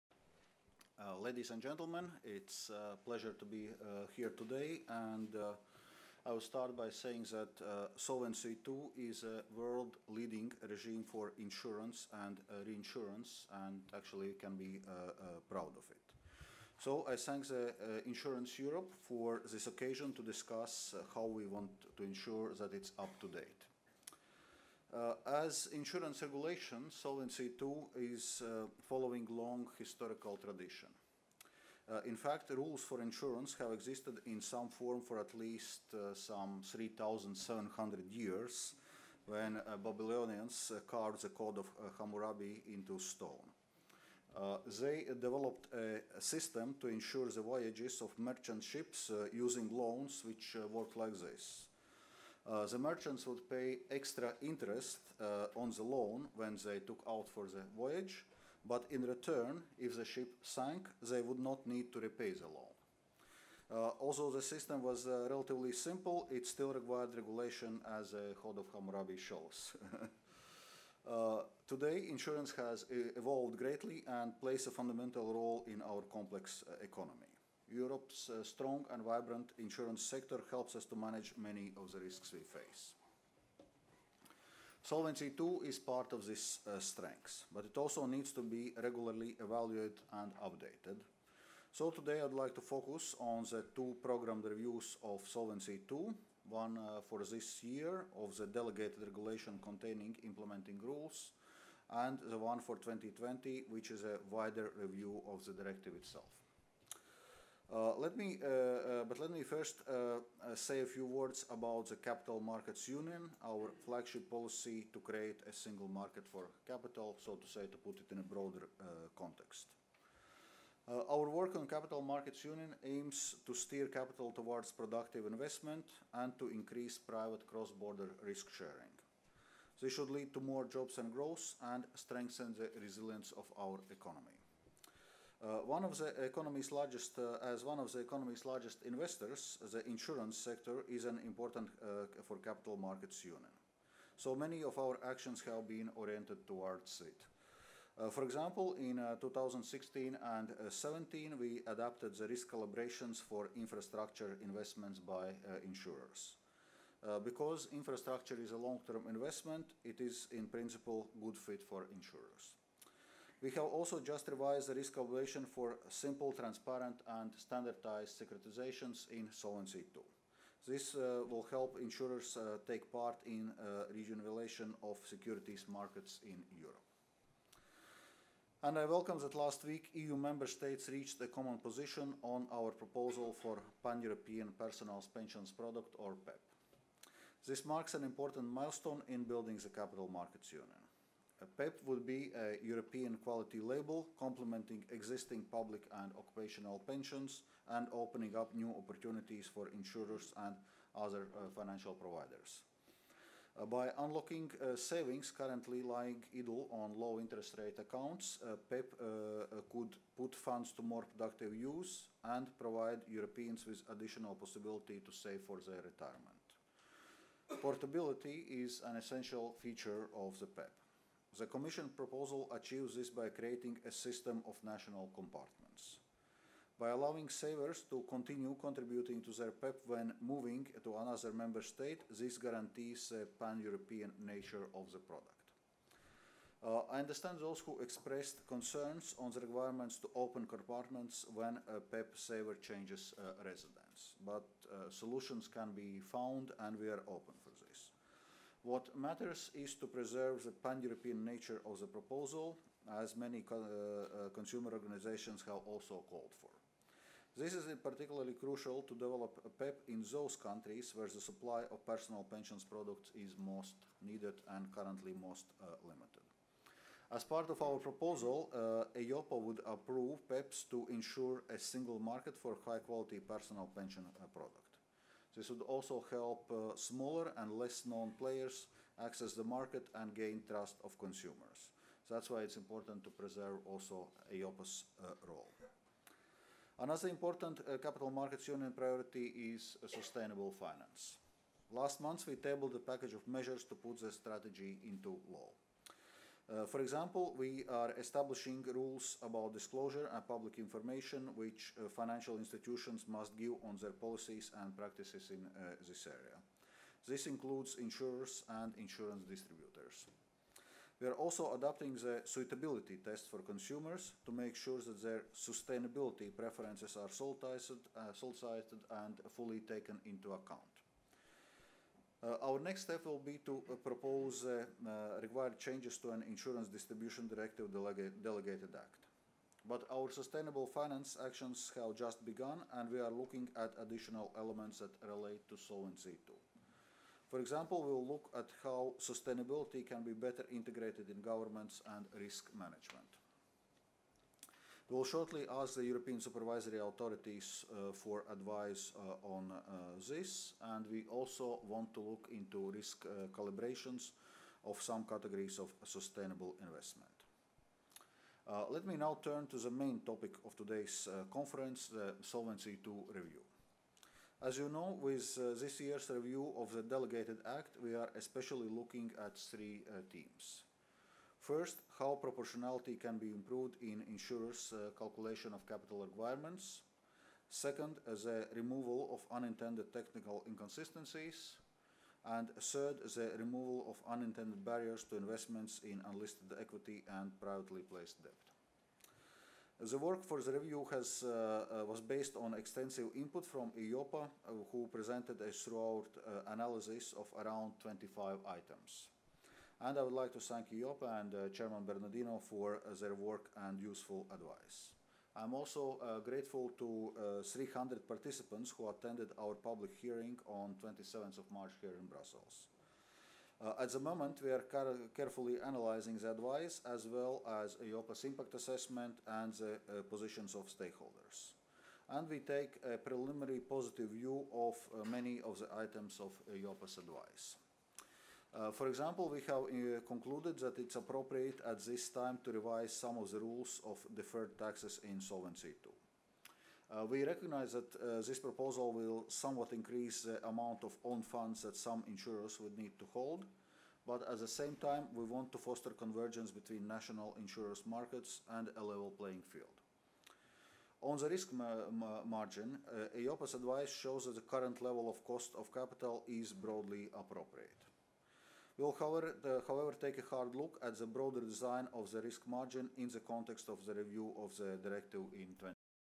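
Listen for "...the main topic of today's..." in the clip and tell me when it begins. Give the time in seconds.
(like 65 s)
359 s.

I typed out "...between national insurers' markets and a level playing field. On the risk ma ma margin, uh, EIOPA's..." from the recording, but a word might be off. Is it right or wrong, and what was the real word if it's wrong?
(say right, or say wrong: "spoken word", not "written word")
right.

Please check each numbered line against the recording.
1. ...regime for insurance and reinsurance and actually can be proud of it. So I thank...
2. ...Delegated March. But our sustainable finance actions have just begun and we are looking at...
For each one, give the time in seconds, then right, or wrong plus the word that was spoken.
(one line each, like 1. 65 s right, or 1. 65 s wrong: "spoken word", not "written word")
1. 10 s right
2. 328 s wrong: "Act", not "March".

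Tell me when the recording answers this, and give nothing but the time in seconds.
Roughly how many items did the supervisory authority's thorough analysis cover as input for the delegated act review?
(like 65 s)
397 s.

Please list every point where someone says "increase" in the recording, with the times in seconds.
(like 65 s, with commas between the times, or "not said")
126 s, 439 s.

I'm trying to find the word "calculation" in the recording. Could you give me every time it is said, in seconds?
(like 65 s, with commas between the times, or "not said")
164 s, 374 s.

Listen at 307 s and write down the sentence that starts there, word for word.
This includes insurers and insurance distributors.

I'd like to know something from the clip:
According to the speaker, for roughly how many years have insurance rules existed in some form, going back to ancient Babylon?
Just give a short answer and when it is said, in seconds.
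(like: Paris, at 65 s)
3,700, at 36 s.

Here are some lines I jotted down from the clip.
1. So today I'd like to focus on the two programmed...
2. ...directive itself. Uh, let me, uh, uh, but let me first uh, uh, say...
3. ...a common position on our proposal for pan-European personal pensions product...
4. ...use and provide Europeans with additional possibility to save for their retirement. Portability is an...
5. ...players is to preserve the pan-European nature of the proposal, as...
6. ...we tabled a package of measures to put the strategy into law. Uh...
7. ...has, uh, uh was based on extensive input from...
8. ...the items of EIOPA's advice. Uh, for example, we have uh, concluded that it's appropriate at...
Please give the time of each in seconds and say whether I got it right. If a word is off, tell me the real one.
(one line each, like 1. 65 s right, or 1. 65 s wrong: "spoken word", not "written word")
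1. 91 s right
2. 105 s right
3. 181 s right
4. 211 s right
5. 248 s wrong: "matters", not "players"
6. 292 s right
7. 390 s right
8. 425 s right.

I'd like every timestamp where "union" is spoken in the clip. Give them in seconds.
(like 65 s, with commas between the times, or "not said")
112 s, 122 s, 143 s, 190 s, 288 s.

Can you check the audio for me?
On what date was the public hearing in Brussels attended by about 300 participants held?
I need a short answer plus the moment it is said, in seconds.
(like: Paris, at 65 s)
27 March, at 410 s.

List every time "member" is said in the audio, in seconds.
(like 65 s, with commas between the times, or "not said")
180 s, 231 s.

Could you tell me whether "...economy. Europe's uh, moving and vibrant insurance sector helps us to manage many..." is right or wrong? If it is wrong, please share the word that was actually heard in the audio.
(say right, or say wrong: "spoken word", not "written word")
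wrong: "strong", not "moving".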